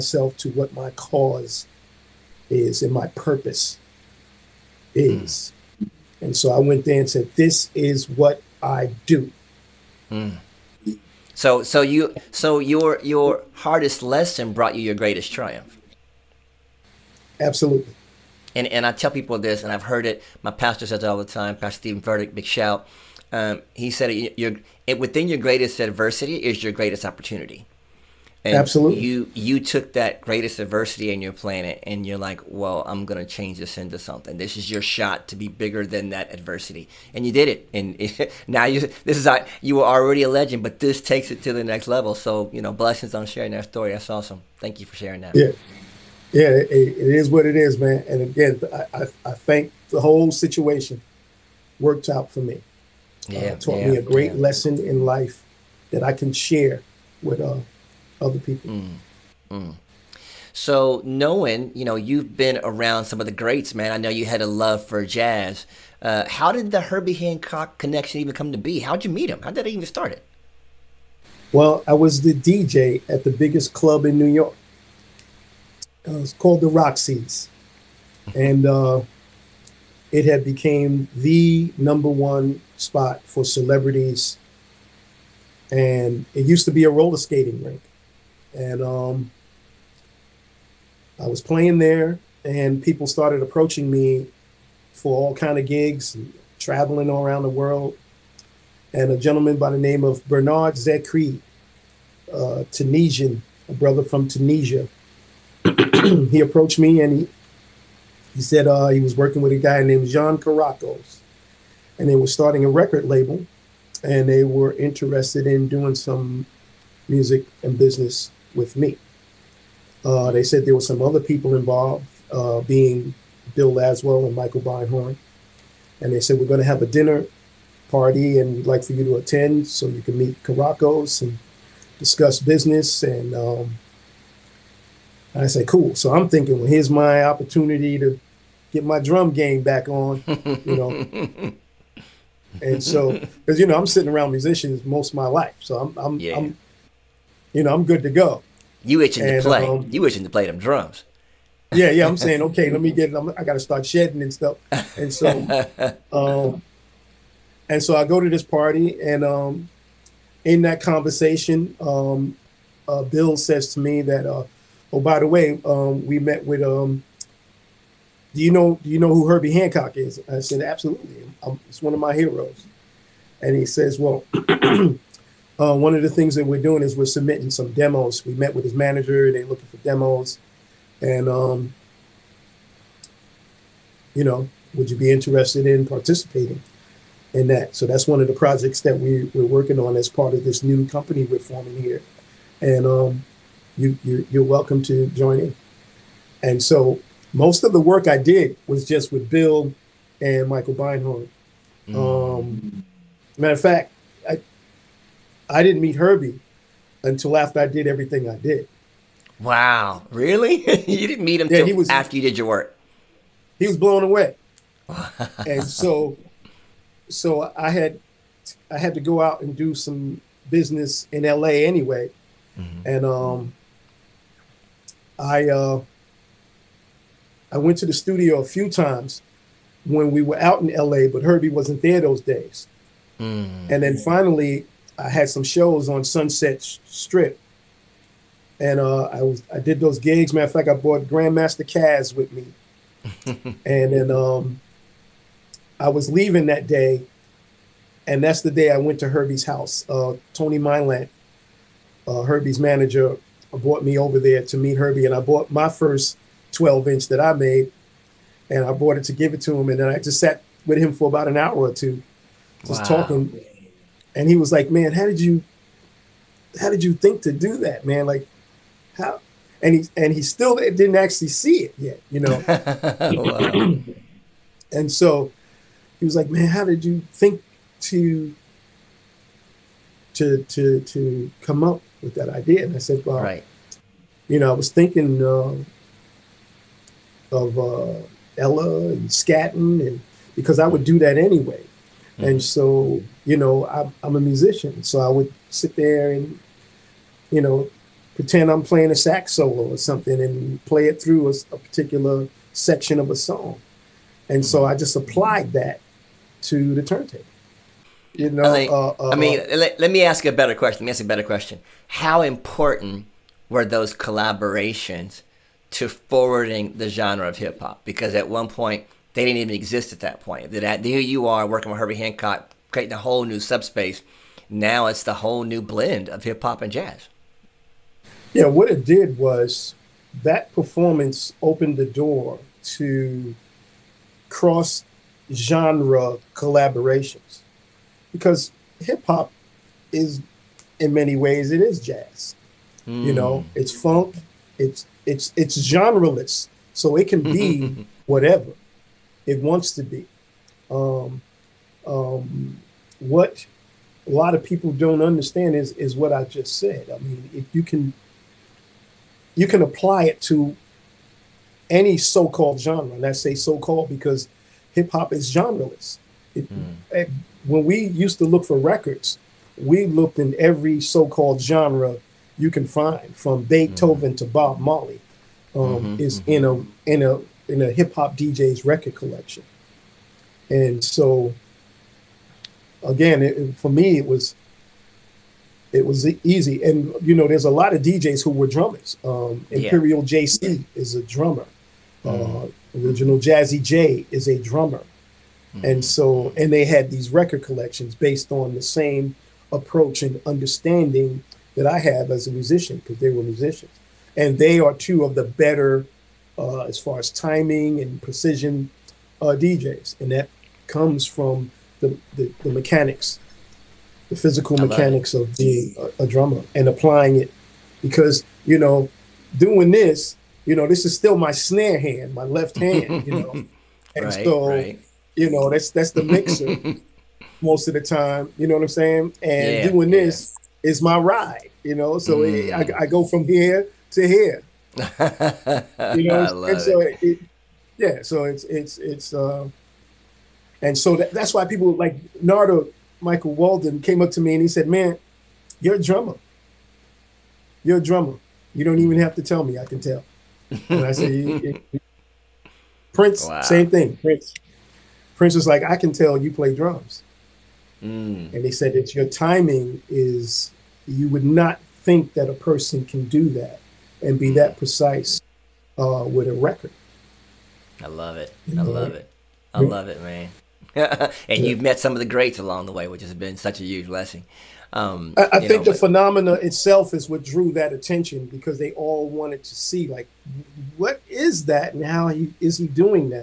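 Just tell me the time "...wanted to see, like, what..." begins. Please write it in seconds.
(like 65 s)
479 s.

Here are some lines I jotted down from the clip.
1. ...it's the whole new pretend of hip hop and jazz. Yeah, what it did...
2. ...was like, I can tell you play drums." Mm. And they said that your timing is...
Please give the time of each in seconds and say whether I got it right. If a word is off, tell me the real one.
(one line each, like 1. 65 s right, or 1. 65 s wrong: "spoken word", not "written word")
1. 324 s wrong: "blend", not "pretend"
2. 455 s right.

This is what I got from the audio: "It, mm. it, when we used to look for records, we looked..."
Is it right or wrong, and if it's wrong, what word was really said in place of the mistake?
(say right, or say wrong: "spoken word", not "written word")
right.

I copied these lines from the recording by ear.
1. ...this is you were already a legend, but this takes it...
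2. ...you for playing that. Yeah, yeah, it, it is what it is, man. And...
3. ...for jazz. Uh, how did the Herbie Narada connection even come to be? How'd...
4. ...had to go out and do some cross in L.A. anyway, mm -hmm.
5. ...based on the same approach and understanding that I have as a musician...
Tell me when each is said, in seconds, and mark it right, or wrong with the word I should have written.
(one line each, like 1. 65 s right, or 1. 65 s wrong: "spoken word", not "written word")
1. 39 s right
2. 44 s wrong: "sharing", not "playing"
3. 64 s wrong: "Hancock", not "Narada"
4. 218 s wrong: "business", not "cross"
5. 397 s right.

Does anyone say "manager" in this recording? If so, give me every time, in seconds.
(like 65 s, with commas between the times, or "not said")
178 s, 252 s.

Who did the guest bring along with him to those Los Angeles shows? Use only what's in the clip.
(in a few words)
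Grandmaster Caz.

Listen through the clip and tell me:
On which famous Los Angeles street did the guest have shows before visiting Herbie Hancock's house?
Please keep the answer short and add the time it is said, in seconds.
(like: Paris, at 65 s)
Sunset Strip, at 236 s.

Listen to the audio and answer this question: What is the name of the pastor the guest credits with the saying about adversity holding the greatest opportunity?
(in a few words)
Stephen Verdict.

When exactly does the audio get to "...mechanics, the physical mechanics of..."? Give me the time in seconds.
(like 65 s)
412 s.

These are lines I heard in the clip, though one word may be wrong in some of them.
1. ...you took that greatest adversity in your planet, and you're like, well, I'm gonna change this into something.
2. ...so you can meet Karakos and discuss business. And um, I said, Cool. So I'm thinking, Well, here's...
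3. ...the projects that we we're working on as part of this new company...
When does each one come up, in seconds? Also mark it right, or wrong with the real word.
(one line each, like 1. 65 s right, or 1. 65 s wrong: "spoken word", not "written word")
1. 29 s right
2. 129 s right
3. 188 s right.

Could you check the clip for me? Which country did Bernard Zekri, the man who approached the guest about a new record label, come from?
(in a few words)
Tunisia.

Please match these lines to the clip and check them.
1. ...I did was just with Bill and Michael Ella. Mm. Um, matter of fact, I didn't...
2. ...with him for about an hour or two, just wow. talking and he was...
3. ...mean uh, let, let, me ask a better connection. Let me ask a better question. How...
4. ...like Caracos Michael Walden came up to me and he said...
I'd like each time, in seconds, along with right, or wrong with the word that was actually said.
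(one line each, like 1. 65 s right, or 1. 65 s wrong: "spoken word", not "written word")
1. 198 s wrong: "Beinhorn", not "Ella"
2. 260 s right
3. 309 s wrong: "question", not "connection"
4. 441 s wrong: "Narada", not "Caracos".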